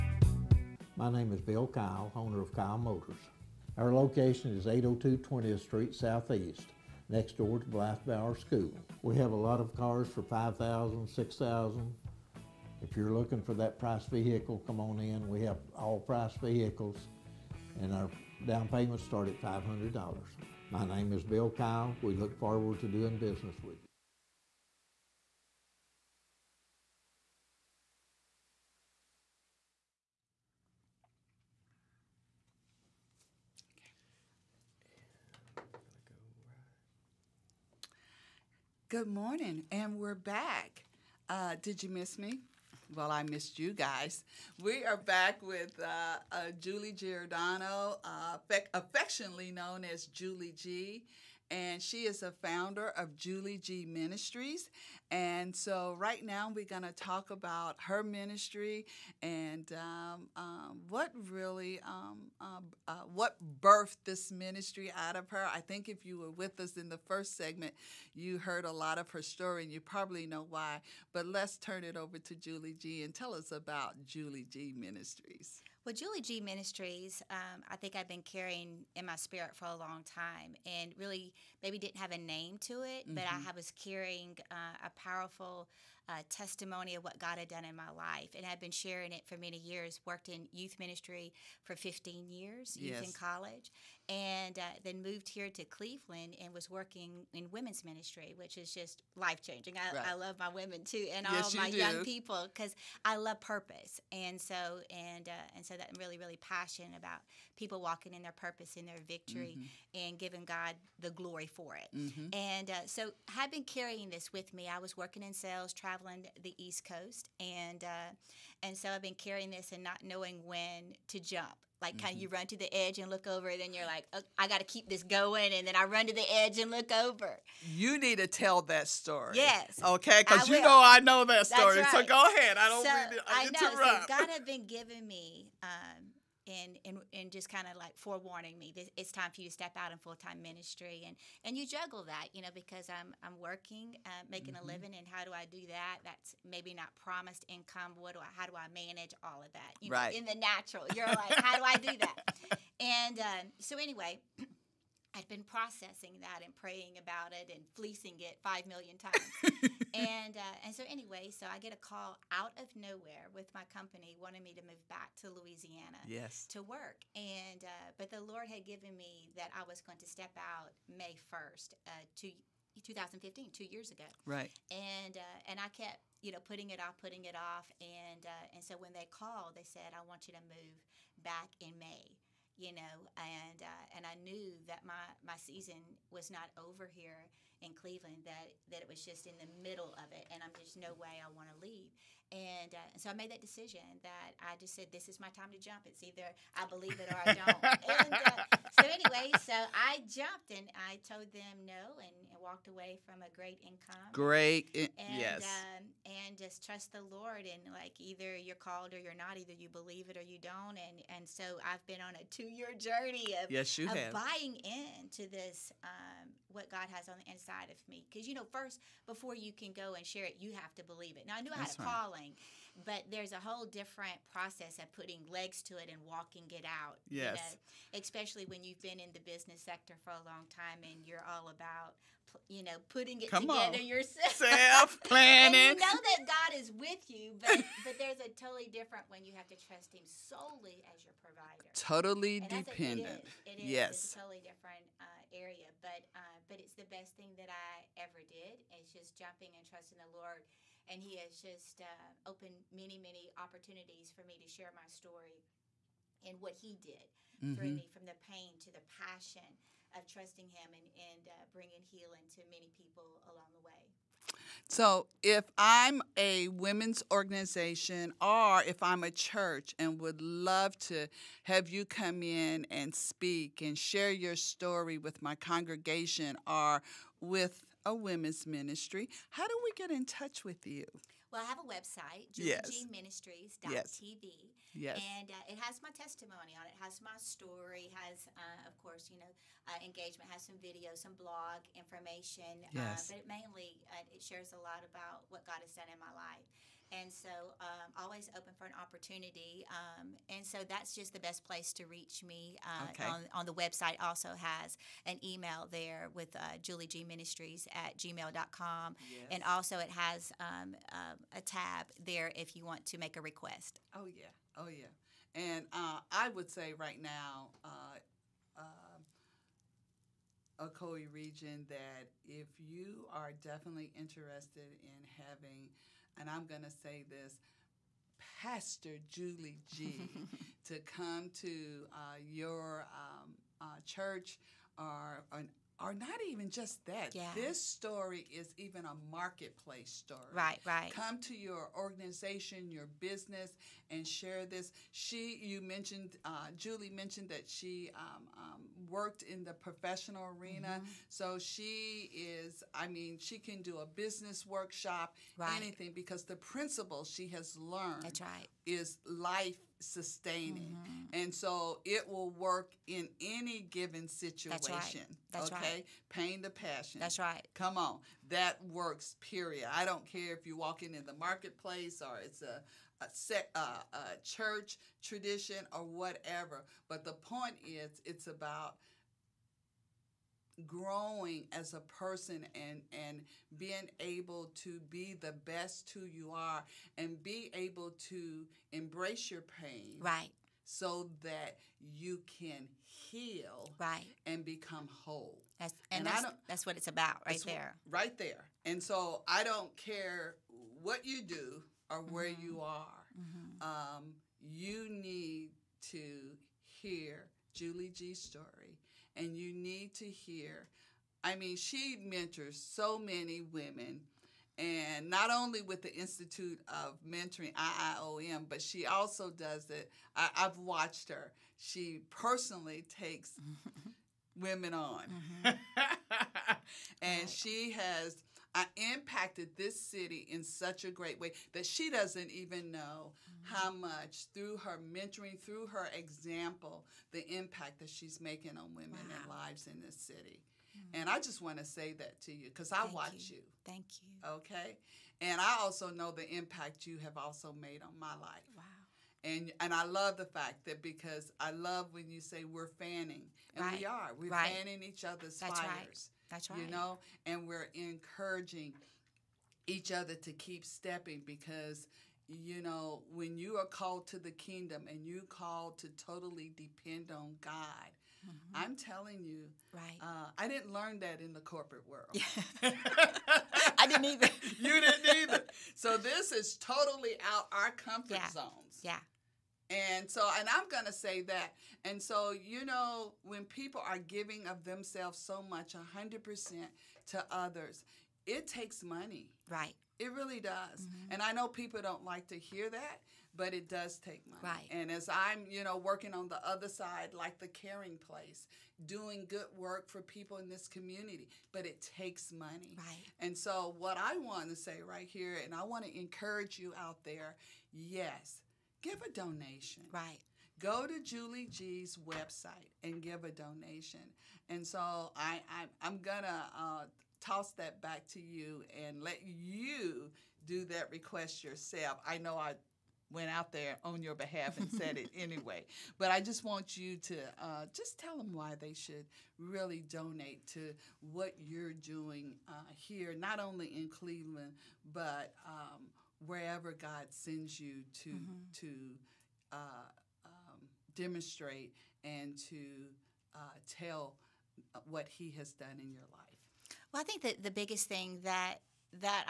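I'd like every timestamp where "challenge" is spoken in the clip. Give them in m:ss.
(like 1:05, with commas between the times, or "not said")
not said.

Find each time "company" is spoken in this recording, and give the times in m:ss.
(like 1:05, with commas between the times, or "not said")
2:43.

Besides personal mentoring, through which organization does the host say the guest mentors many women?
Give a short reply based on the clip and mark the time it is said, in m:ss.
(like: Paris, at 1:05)
Institute of Mentoring, at 6:55.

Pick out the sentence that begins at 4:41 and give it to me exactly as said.
Well, I have a website, julieministries.tv.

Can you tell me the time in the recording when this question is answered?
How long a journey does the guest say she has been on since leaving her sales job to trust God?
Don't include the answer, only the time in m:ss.
3:32.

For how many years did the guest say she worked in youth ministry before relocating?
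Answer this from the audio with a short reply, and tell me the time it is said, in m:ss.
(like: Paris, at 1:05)
15, at 1:31.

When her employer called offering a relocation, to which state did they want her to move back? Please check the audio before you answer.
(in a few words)
Louisiana.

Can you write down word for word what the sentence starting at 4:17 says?
through me from the pain to the passion of trusting Him and, and uh, bringing healing to many people along the way.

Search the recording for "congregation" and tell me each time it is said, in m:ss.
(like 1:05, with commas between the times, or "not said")
4:35.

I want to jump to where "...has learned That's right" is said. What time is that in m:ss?
5:57.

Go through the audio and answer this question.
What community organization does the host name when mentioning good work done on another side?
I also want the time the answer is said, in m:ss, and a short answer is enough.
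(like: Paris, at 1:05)
the caring place, at 8:17.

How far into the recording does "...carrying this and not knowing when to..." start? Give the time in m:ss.
1:59.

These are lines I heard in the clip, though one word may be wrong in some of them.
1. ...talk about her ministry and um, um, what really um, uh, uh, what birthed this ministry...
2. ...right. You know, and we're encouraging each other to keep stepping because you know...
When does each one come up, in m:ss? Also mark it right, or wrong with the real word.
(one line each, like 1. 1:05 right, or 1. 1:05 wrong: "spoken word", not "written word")
1. 0:56 right
2. 7:36 right.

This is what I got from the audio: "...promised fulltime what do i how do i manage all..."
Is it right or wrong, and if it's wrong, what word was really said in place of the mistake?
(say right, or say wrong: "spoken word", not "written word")
wrong: "income", not "fulltime".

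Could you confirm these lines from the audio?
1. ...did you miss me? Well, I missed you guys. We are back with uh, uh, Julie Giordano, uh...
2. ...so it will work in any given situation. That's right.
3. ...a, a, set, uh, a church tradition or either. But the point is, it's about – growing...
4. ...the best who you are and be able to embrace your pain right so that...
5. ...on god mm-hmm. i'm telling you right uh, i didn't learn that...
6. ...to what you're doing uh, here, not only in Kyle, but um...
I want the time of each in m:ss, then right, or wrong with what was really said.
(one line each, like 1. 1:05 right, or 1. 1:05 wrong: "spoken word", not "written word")
1. 0:41 right
2. 6:01 right
3. 6:12 wrong: "whatever", not "either"
4. 6:25 right
5. 7:47 right
6. 8:50 wrong: "Cleveland", not "Kyle".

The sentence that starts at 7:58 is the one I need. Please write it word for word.
zones yeah and so, and I'm going to say that.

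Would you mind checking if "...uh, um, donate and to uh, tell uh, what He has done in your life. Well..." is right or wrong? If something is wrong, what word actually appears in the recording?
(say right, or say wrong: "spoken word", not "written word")
wrong: "demonstrate", not "donate".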